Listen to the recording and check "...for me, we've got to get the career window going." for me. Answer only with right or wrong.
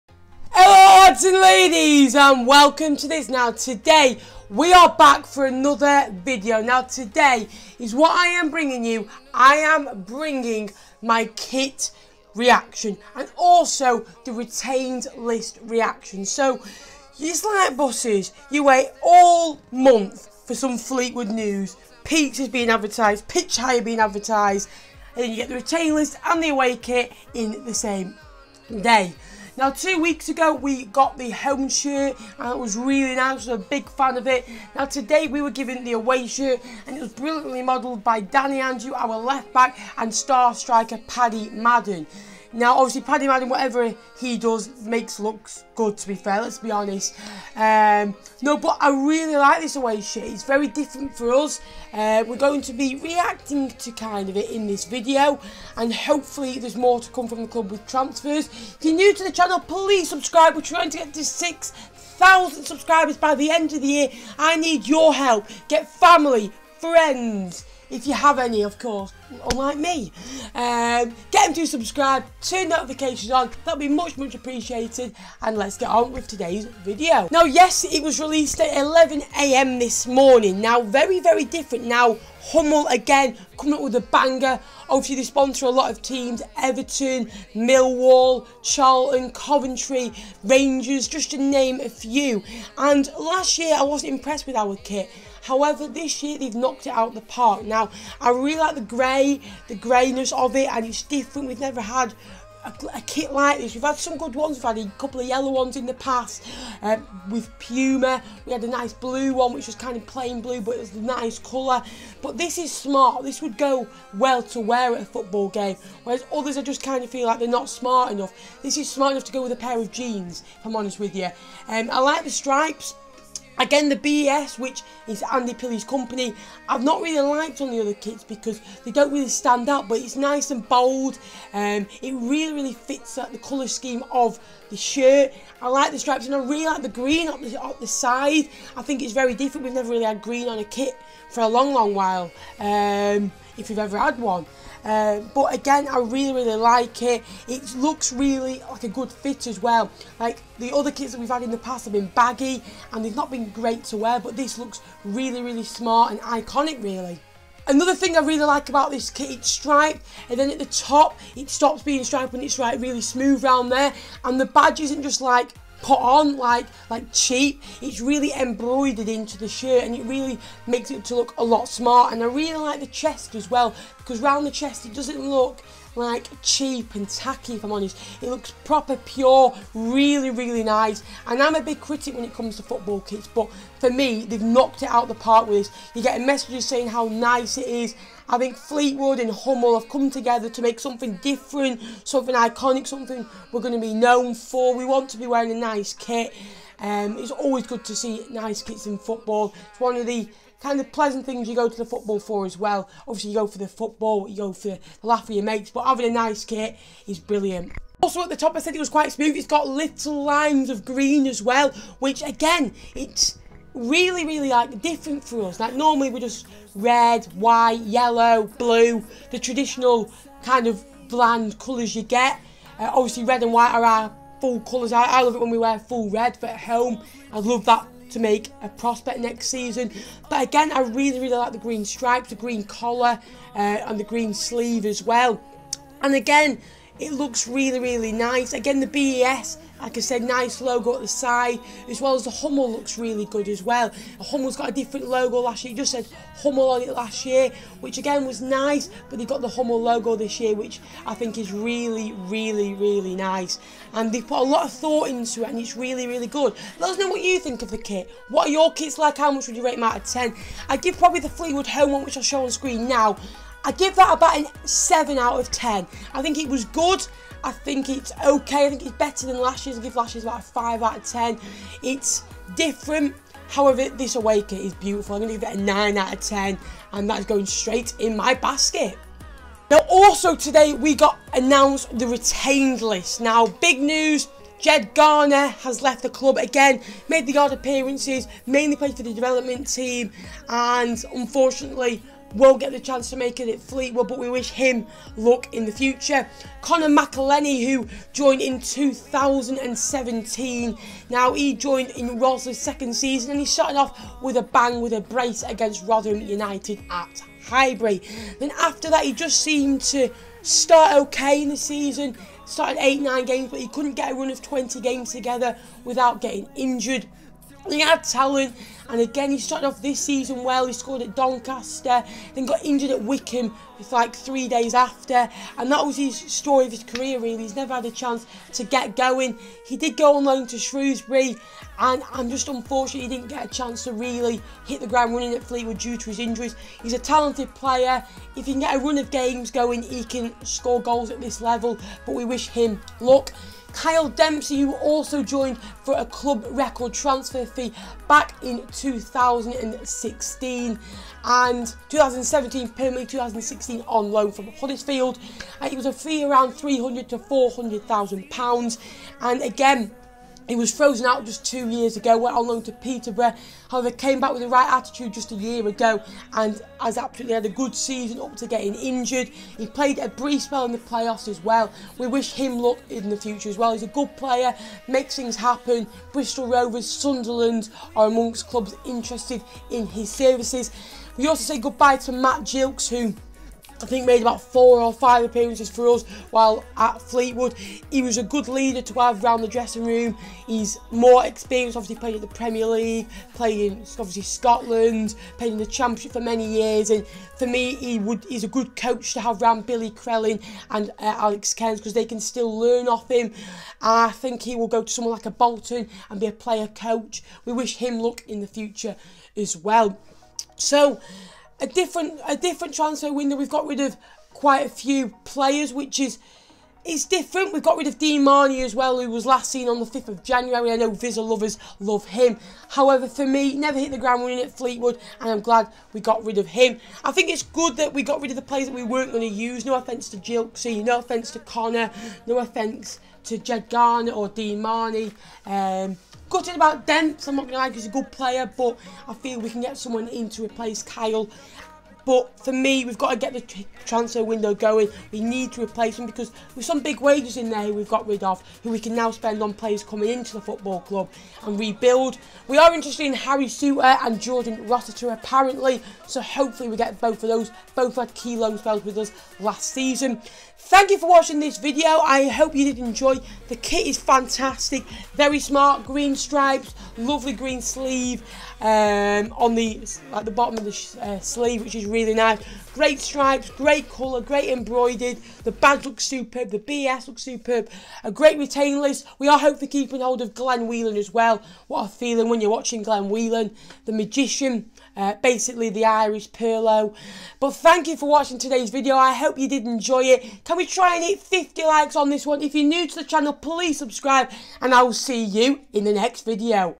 wrong.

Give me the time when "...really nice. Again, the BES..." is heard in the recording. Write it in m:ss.
3:57.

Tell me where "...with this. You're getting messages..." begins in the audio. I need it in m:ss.
3:05.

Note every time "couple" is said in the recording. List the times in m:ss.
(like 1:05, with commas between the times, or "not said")
1:44.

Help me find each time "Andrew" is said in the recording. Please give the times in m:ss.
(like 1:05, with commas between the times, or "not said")
0:38.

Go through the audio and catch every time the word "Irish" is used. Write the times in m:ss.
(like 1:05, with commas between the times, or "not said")
8:05.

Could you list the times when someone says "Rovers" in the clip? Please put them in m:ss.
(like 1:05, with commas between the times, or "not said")
6:16.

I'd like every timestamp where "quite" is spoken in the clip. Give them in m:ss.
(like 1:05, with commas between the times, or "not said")
3:28, 6:54.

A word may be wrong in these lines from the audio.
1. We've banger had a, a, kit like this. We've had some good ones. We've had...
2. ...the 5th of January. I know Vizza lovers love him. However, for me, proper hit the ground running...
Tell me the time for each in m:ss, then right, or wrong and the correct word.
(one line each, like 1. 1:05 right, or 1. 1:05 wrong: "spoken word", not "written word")
1. 1:41 wrong: "never", not "banger"
2. 6:59 wrong: "never", not "proper".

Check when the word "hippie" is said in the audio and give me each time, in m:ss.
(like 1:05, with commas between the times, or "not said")
not said.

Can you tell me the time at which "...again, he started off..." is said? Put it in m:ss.
5:18.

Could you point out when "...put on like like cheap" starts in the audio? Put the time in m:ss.
2:45.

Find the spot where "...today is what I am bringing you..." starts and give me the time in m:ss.
0:06.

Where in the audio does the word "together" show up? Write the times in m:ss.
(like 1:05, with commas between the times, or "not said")
3:10, 5:15.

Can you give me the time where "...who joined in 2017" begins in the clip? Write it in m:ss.
4:57.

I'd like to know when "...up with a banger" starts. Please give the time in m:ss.
1:23.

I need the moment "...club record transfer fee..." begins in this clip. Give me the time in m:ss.
5:46.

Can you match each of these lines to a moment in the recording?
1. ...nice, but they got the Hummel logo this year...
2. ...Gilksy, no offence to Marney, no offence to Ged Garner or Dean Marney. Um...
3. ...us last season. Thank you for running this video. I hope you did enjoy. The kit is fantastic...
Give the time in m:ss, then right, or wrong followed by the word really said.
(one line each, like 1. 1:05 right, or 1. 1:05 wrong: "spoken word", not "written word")
1. 4:08 right
2. 7:10 wrong: "Conor", not "Marney"
3. 7:38 wrong: "watching", not "running".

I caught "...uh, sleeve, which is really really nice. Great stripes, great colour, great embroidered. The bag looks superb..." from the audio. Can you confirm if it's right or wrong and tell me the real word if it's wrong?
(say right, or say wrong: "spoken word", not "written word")
right.